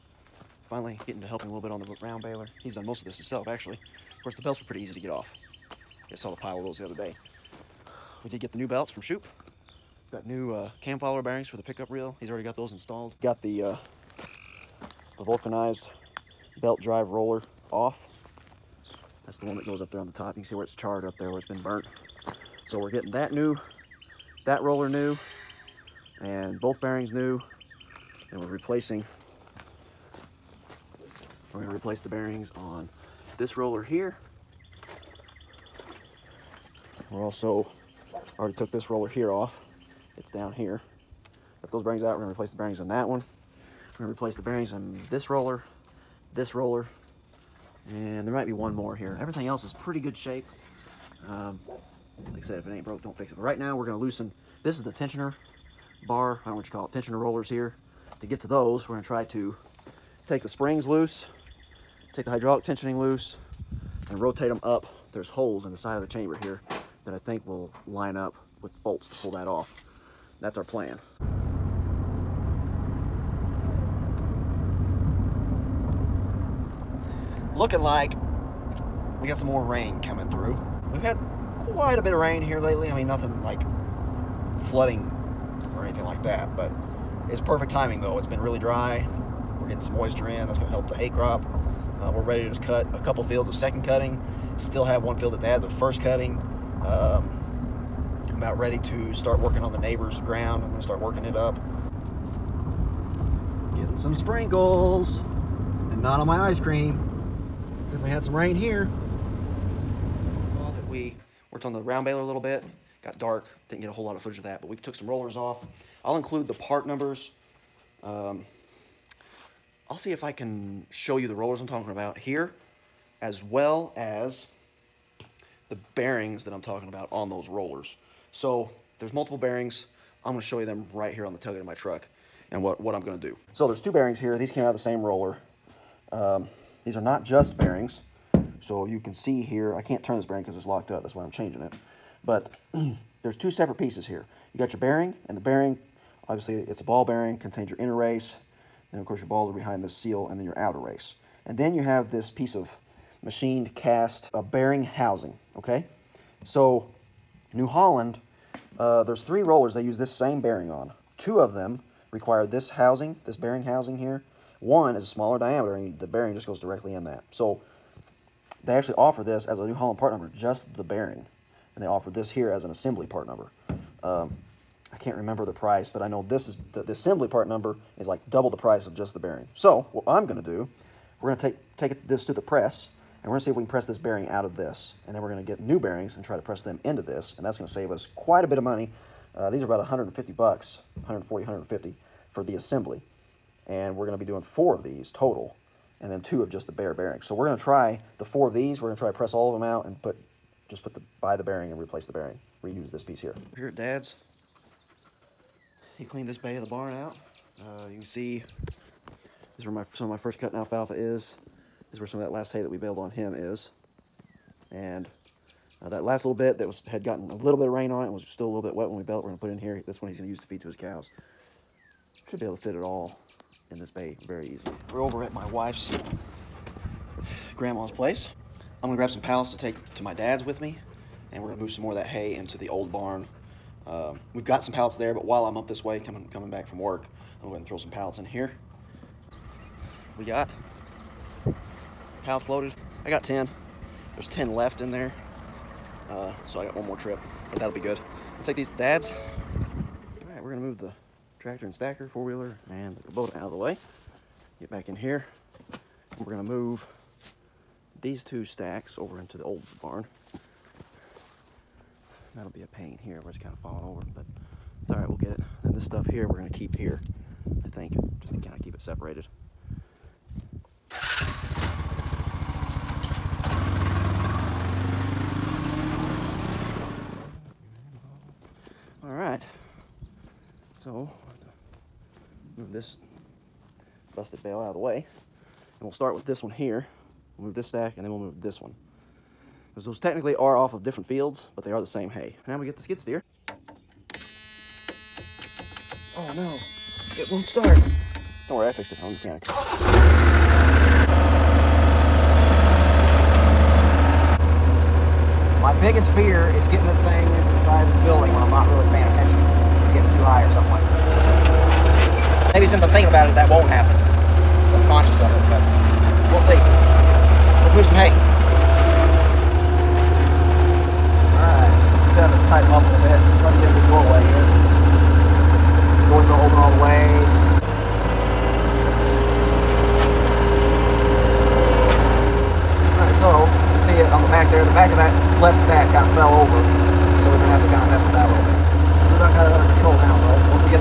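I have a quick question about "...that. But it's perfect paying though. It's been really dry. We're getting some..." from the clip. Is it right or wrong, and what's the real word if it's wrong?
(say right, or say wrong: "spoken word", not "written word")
wrong: "timing", not "paying".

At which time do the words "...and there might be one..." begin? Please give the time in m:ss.
0:47.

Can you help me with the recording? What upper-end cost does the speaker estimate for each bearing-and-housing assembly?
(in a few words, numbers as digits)
$150.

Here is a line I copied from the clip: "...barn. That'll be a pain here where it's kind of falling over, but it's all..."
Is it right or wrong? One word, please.
right.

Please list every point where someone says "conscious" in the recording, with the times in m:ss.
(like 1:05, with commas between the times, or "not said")
5:14.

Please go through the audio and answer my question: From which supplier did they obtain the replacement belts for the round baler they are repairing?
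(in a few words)
Shoup.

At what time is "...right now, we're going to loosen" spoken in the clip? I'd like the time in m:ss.
0:53.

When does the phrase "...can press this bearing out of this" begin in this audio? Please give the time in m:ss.
3:03.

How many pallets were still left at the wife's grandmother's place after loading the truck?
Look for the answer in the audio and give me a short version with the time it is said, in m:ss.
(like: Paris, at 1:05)
10, at 4:04.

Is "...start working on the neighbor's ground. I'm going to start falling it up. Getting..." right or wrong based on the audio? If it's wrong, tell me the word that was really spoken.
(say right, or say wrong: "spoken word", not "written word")
wrong: "working", not "falling".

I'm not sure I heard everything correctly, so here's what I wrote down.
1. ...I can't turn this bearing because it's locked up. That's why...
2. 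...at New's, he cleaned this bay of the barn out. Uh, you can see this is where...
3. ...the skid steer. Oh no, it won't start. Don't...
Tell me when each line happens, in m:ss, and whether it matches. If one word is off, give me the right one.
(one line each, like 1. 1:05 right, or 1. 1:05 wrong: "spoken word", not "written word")
1. 2:19 right
2. 3:23 wrong: "Dad", not "New"
3. 4:52 right.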